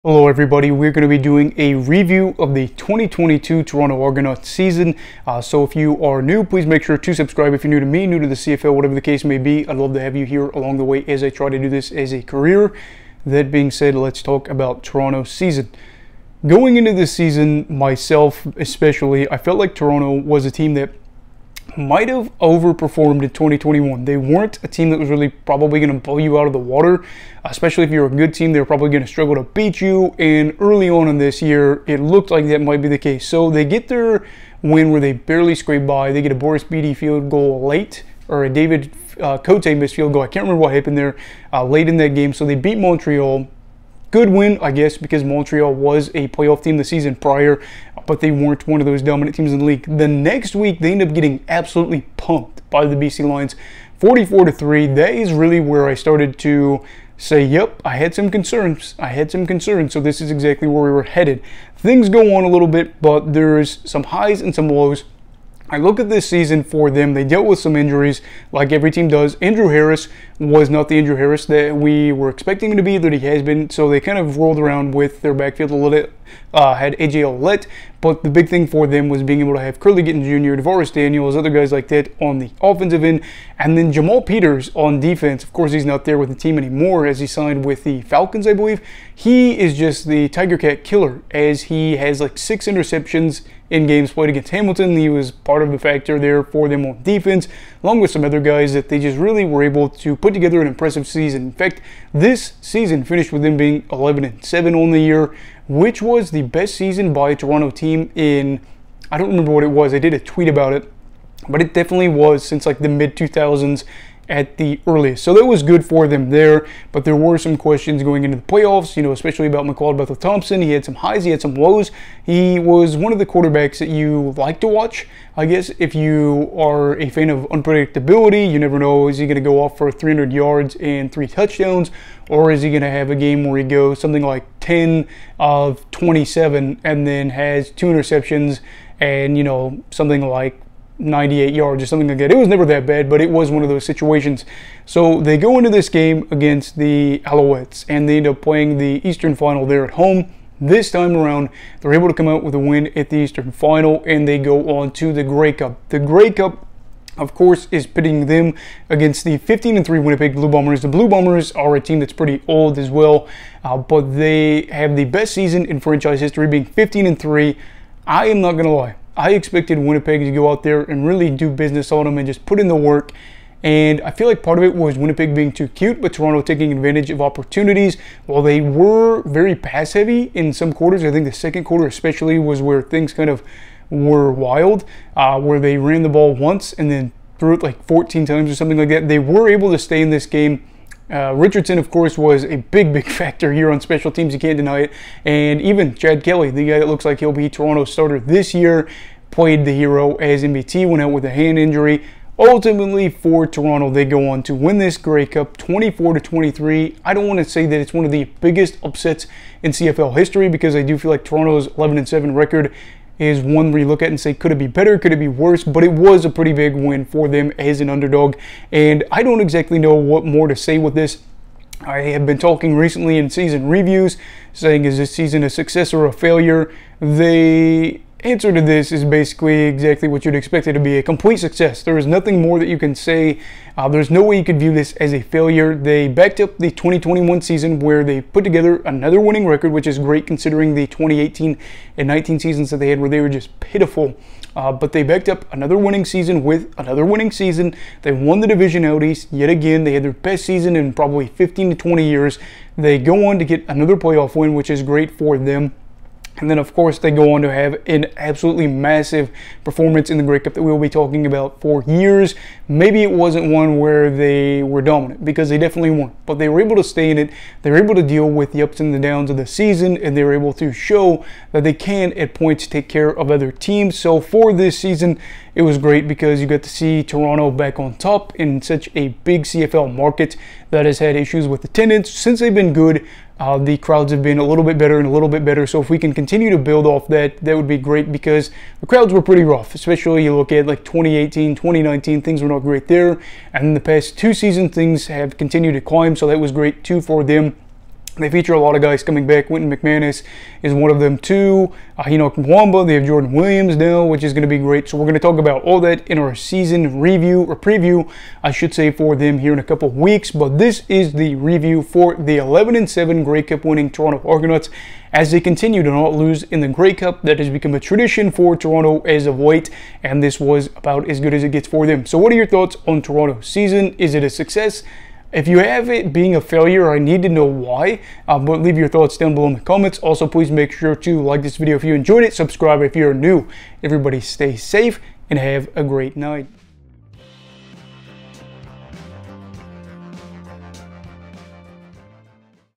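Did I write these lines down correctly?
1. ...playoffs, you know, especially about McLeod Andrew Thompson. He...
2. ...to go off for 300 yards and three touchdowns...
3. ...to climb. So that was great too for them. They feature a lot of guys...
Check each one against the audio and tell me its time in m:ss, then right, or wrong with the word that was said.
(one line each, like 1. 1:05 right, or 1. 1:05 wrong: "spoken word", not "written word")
1. 1:58 wrong: "Bethel", not "Andrew"
2. 2:09 right
3. 4:55 right.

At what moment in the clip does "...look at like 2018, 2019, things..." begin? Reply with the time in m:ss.
4:50.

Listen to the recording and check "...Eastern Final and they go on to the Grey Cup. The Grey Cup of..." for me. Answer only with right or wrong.
right.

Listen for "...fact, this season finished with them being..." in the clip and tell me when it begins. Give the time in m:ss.
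1:41.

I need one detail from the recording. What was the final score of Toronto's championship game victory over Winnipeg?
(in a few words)
24 to 23.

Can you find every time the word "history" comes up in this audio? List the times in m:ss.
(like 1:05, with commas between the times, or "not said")
2:46, 3:30.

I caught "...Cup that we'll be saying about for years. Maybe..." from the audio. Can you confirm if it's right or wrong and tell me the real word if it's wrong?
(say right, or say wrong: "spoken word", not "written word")
wrong: "talking", not "saying".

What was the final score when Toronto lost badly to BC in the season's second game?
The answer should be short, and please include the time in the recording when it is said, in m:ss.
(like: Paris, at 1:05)
44 to 3, at 0:54.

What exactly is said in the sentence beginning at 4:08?
They won the division out east yet again.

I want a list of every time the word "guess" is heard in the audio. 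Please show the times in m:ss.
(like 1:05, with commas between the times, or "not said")
0:44, 2:05.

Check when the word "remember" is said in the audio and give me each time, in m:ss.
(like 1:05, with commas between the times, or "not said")
0:40, 1:49.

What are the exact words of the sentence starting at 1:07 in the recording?
They dealt with some injuries, like every team does.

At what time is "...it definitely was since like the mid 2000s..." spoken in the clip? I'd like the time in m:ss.
1:51.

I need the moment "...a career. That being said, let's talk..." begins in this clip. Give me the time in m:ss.
0:12.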